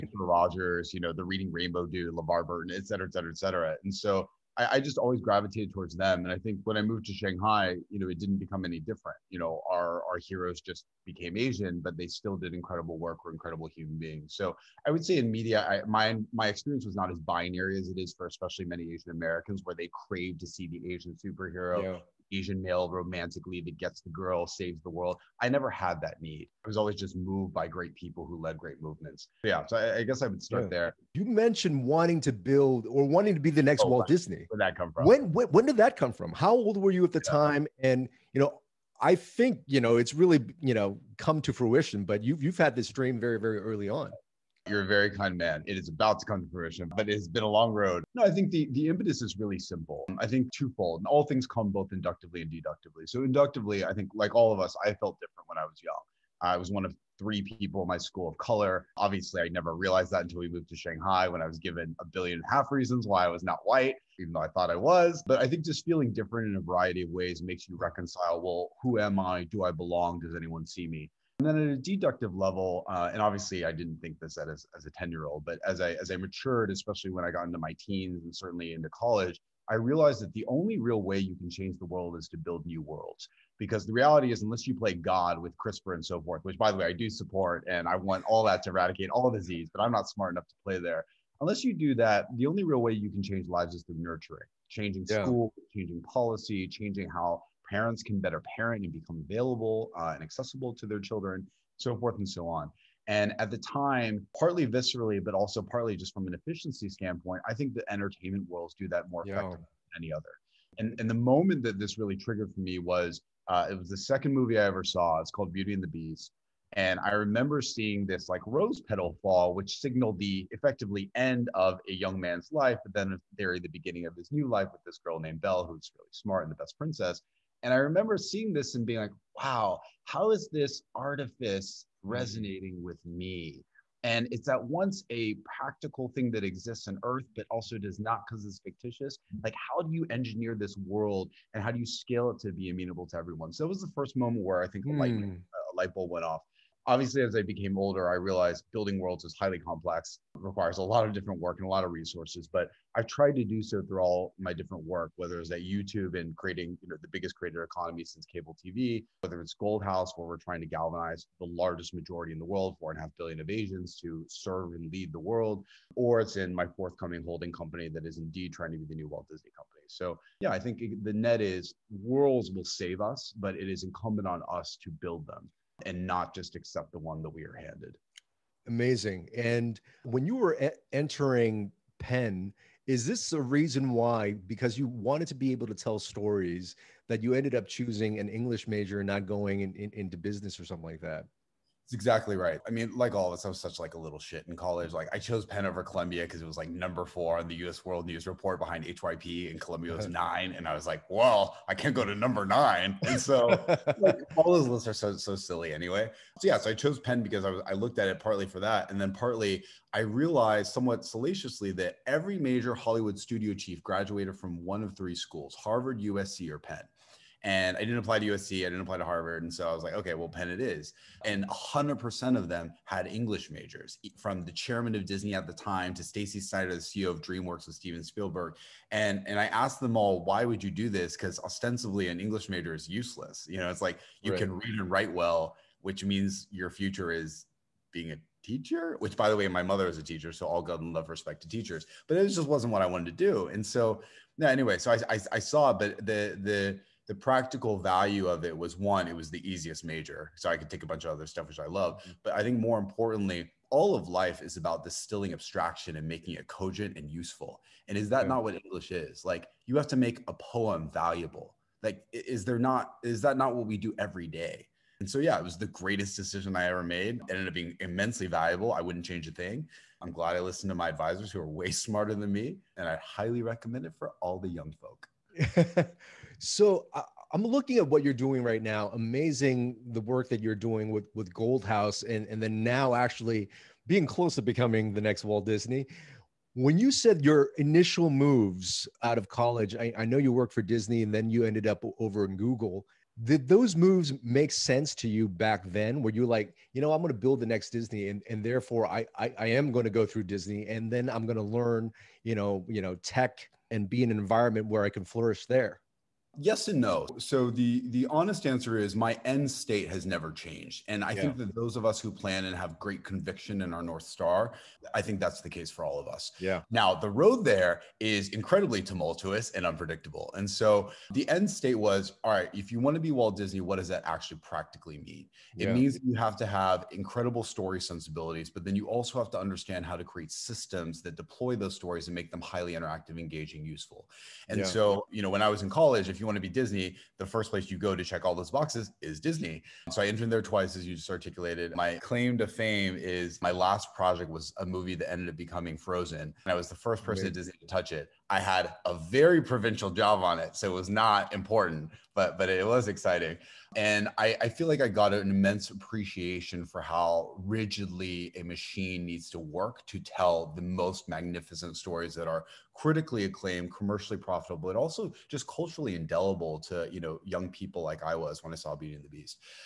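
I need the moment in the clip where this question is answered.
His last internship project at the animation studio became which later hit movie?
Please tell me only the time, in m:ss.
5:45.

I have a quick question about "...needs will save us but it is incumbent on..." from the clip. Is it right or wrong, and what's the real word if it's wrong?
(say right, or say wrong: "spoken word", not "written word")
wrong: "worlds", not "needs".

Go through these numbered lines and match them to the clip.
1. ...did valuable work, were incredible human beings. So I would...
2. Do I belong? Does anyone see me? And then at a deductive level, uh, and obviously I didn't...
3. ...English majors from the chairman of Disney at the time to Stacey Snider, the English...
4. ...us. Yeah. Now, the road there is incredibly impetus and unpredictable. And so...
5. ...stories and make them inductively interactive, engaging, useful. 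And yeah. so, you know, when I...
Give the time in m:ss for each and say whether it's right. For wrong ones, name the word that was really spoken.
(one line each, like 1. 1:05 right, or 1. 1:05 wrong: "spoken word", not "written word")
1. 0:12 wrong: "incredible", not "valuable"
2. 1:09 right
3. 3:43 wrong: "CEO", not "English"
4. 5:16 wrong: "tumultuous", not "impetus"
5. 5:31 wrong: "highly", not "inductively".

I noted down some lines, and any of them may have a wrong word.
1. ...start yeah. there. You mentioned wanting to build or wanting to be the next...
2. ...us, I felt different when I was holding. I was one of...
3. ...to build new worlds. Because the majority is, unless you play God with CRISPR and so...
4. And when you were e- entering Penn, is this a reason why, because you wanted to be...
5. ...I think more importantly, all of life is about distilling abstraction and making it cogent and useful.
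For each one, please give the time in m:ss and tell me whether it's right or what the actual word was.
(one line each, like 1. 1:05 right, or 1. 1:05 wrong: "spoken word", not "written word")
1. 0:30 right
2. 0:54 wrong: "young", not "holding"
3. 1:22 wrong: "reality", not "majority"
4. 2:59 right
5. 4:12 right.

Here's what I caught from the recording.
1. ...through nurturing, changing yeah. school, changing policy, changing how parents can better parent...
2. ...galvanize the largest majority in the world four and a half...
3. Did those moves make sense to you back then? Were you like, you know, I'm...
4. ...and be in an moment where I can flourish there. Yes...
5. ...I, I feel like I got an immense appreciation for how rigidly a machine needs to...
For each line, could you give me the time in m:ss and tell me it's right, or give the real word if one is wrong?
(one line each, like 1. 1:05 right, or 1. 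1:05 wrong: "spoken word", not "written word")
1. 1:33 right
2. 2:40 right
3. 4:53 right
4. 5:03 wrong: "environment", not "moment"
5. 5:54 right.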